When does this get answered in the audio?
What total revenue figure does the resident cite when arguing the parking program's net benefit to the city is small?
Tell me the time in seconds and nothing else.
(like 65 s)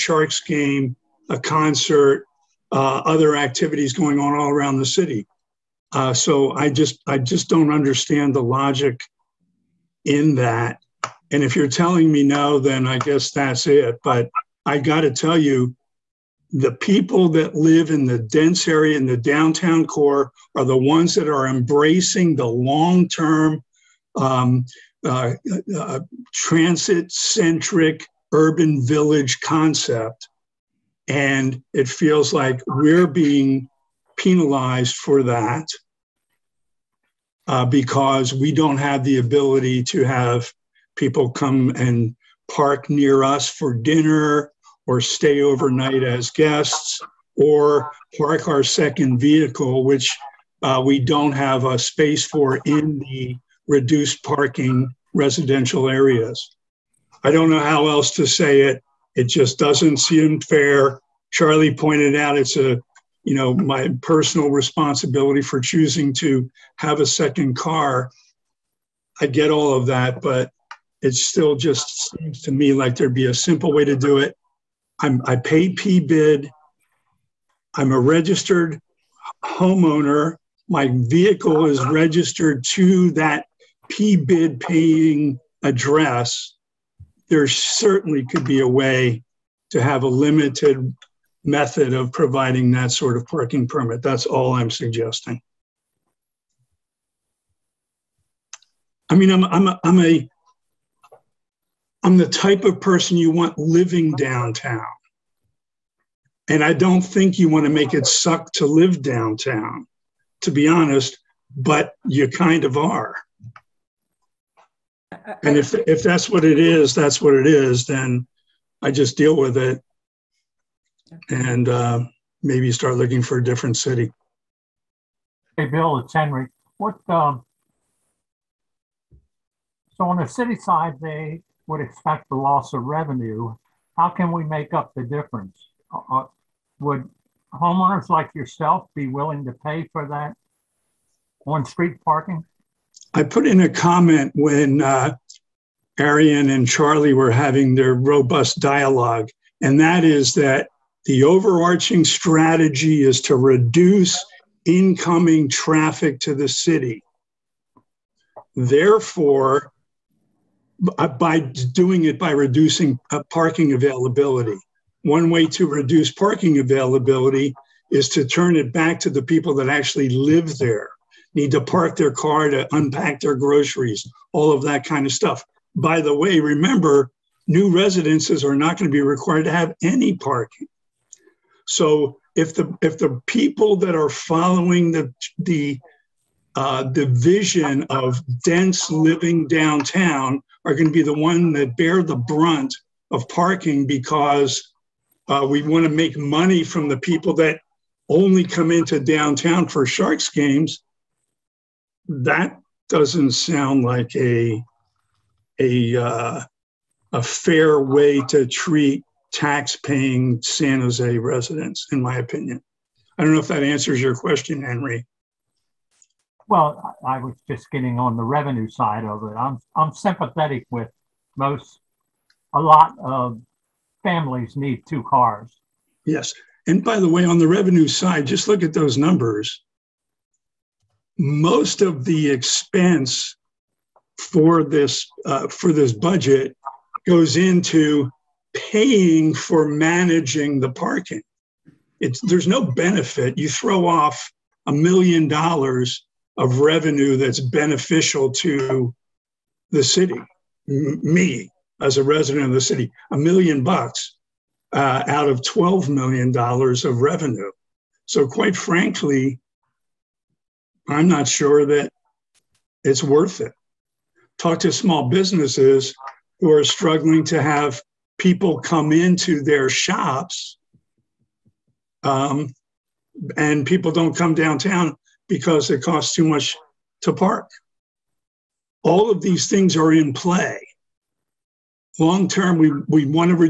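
255 s.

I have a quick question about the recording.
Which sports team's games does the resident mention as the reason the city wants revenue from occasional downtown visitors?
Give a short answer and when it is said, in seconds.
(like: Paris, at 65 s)
Sharks, at 199 s.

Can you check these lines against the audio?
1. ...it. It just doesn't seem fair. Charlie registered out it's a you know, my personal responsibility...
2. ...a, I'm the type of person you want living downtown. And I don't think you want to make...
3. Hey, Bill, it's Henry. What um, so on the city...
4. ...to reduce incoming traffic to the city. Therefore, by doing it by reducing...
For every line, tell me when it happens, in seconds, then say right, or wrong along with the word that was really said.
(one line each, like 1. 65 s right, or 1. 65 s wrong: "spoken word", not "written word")
1. 58 s wrong: "pointed", not "registered"
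2. 99 s right
3. 125 s right
4. 153 s right.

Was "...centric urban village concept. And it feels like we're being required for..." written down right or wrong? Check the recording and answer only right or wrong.
wrong.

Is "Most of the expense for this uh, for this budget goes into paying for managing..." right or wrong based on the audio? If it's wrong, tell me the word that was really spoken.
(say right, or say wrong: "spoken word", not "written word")
right.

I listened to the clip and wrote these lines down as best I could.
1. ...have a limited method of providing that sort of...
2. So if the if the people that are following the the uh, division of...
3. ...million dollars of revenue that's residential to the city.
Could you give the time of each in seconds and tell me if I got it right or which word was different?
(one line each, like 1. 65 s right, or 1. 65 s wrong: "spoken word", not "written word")
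1. 89 s right
2. 181 s right
3. 244 s wrong: "beneficial", not "residential".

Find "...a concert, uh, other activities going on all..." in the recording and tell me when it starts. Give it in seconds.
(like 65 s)
1 s.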